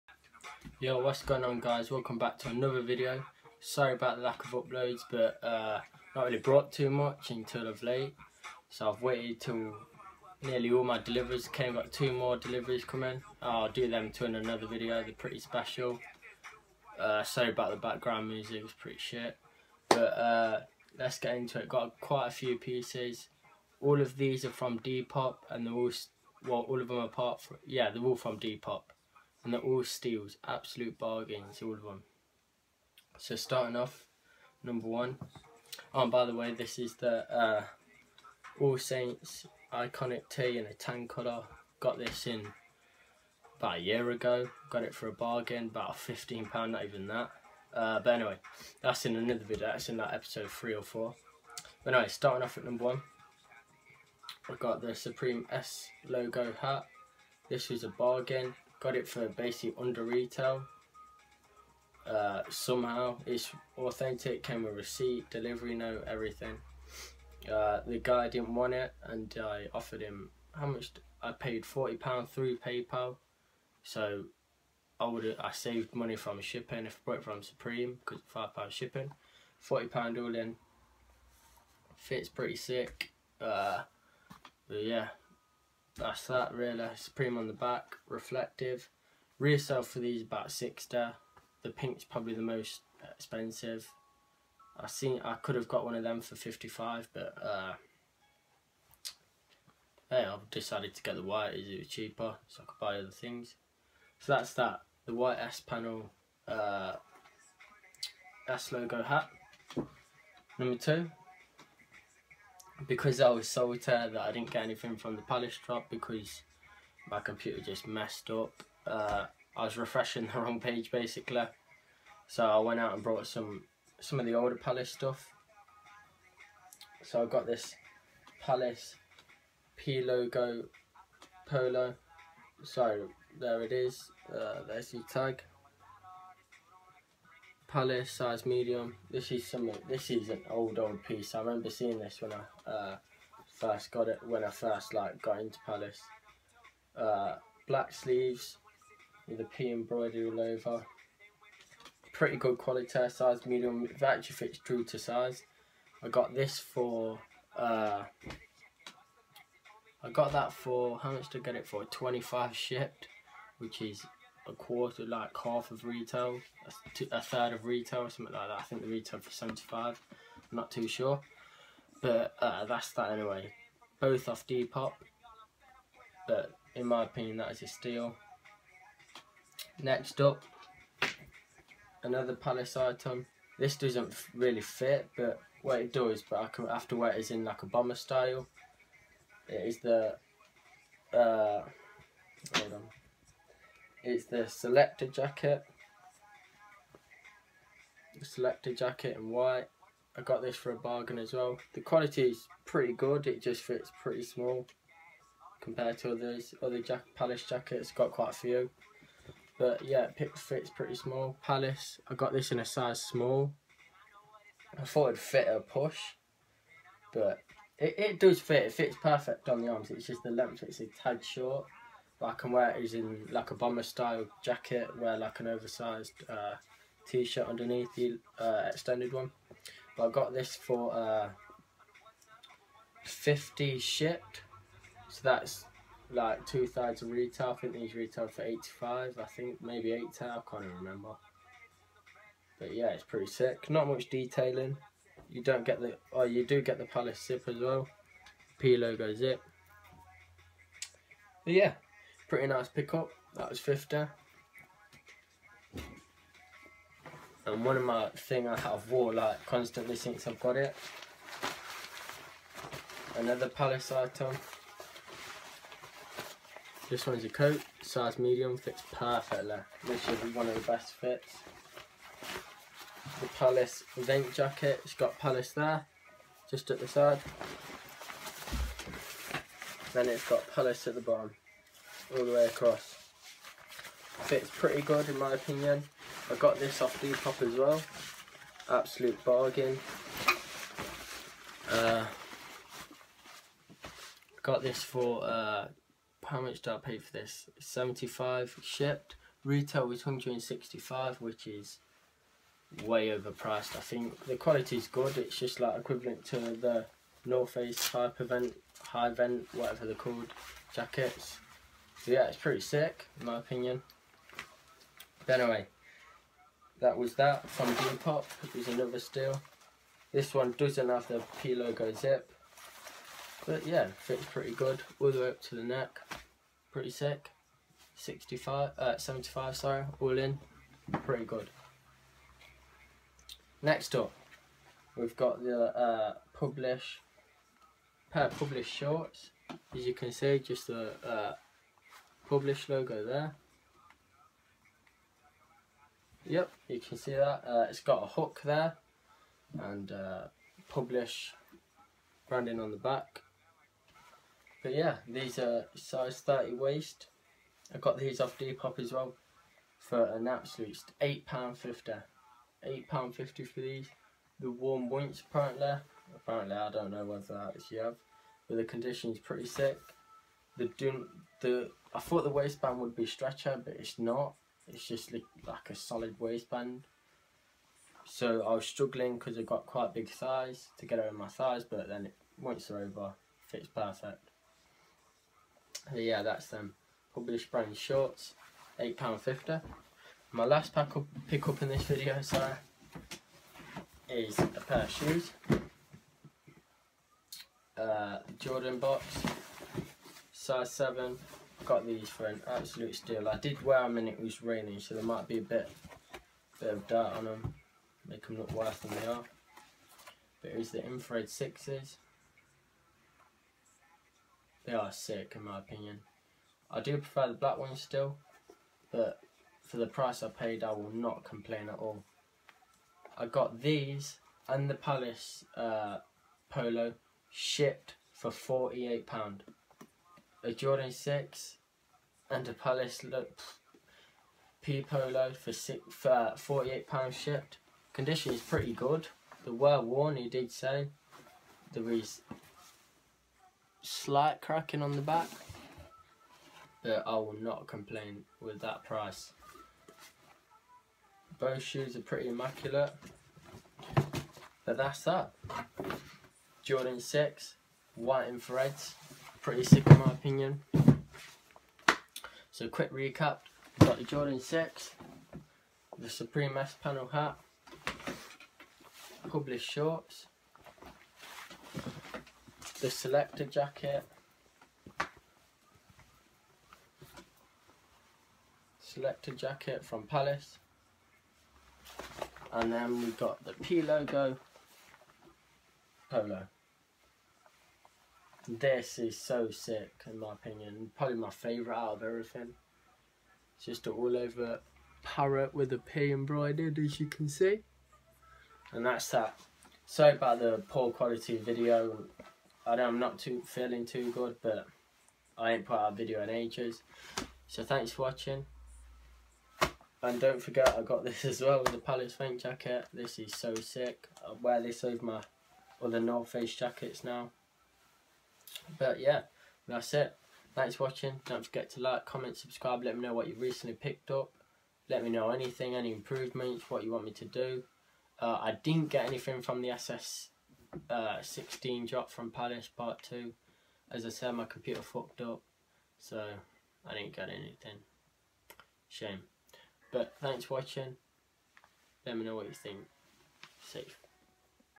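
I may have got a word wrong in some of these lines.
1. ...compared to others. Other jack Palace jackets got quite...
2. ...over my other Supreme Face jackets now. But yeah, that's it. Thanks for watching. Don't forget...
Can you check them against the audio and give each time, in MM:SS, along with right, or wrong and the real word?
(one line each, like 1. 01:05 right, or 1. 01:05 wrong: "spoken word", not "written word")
1. 03:25 right
2. 08:34 wrong: "North", not "Supreme".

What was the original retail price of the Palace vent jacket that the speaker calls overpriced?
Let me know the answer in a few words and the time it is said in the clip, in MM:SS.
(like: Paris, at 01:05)
£165, at 05:00.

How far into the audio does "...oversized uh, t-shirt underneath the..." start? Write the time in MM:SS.
03:45.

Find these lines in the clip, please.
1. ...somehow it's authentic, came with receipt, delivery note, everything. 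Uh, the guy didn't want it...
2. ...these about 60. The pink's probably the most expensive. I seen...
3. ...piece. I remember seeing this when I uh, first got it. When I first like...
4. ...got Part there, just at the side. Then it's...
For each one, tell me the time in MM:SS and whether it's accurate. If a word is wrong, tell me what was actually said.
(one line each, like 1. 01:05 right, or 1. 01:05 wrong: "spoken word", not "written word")
1. 01:02 right
2. 01:29 right
3. 02:21 right
4. 04:34 wrong: "Palace", not "Part".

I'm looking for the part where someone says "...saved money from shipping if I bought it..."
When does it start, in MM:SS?
01:15.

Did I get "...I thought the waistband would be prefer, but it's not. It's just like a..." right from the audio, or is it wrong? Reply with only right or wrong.
wrong.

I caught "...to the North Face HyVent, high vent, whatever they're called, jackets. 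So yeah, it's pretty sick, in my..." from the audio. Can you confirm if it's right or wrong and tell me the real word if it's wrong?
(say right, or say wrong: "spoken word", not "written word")
right.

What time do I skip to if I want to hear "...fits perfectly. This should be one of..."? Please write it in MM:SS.
04:28.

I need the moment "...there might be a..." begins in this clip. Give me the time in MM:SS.
06:44.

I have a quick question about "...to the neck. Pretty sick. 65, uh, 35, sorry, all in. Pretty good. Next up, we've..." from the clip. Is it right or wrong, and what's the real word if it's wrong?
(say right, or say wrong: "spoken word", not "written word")
wrong: "75", not "35".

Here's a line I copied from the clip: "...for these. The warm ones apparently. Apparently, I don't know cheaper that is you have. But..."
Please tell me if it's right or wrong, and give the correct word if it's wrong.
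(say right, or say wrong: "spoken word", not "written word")
wrong: "whether", not "cheaper".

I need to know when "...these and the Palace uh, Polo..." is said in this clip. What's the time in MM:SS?
07:03.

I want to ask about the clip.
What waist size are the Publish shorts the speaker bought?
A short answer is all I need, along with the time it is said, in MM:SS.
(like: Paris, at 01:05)
30, at 05:56.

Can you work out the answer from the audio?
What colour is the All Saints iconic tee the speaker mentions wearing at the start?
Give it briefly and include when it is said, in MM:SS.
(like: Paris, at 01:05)
Tan, at 00:40.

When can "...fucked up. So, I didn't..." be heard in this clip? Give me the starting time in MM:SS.
08:54.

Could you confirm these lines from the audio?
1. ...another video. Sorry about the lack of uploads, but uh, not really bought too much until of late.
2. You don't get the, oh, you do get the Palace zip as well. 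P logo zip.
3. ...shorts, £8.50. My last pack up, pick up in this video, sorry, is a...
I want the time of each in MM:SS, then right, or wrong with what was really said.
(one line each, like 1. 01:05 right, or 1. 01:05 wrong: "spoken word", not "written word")
1. 00:02 wrong: "brought", not "bought"
2. 04:05 right
3. 06:27 right.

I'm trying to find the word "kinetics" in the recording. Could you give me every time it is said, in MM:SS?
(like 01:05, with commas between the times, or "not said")
not said.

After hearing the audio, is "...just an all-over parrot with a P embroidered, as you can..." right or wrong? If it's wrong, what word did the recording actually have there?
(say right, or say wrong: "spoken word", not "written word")
right.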